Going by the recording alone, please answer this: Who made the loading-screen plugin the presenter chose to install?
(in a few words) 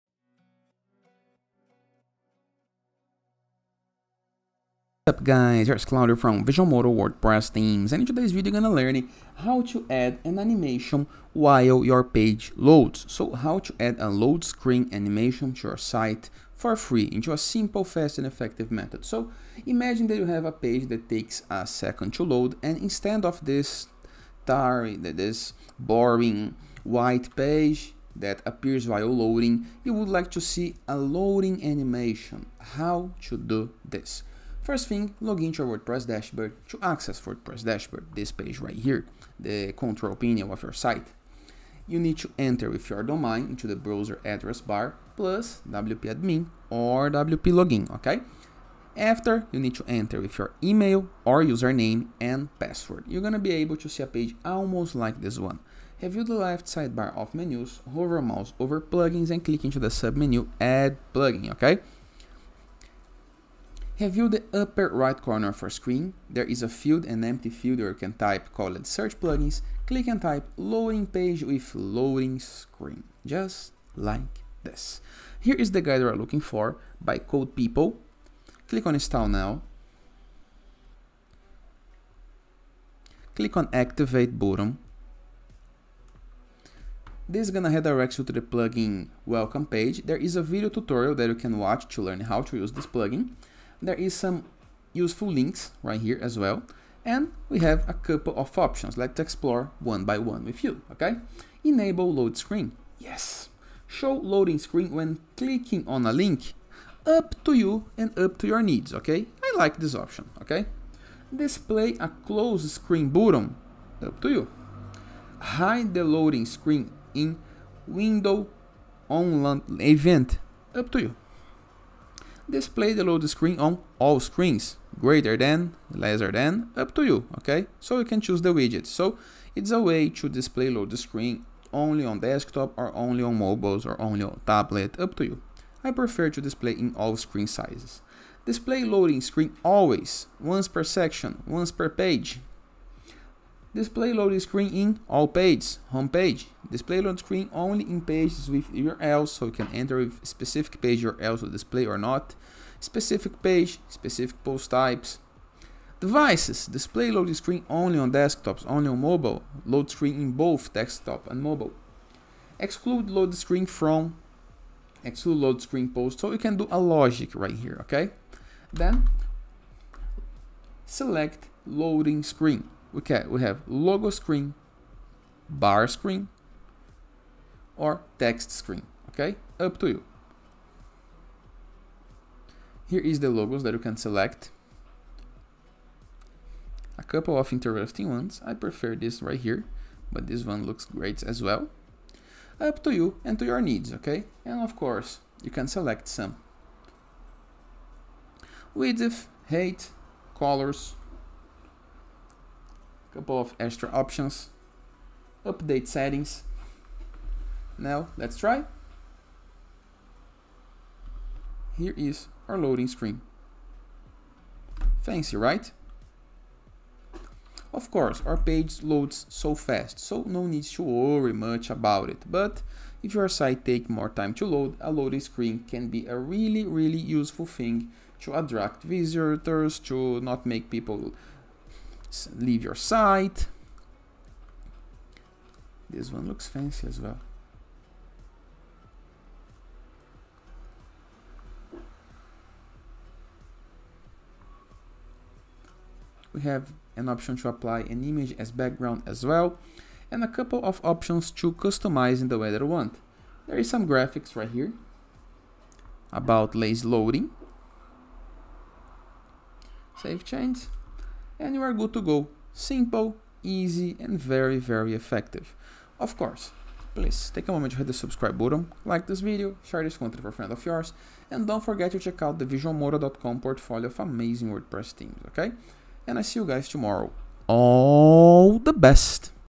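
Code People.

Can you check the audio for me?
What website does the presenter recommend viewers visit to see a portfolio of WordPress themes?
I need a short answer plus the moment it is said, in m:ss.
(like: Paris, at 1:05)
visualmodo.com, at 4:32.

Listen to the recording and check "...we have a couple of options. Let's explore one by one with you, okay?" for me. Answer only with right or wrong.
right.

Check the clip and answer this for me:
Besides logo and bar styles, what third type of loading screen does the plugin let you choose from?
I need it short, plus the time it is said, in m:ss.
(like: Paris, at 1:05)
text screen, at 2:58.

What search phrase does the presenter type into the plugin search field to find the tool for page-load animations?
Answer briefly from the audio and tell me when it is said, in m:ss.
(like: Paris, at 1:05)
loading page with loading screen, at 1:10.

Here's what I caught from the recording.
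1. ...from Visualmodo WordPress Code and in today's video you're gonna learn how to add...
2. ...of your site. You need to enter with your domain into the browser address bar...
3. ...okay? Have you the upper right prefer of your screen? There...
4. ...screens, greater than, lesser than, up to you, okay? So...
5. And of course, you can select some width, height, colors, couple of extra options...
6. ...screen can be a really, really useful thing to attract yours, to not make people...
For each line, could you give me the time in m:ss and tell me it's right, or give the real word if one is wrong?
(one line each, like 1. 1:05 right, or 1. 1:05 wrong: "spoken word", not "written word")
1. 0:06 wrong: "Themes", not "Code"
2. 0:40 right
3. 1:01 wrong: "corner", not "prefer"
4. 2:04 right
5. 3:14 right
6. 3:45 wrong: "visitors", not "yours".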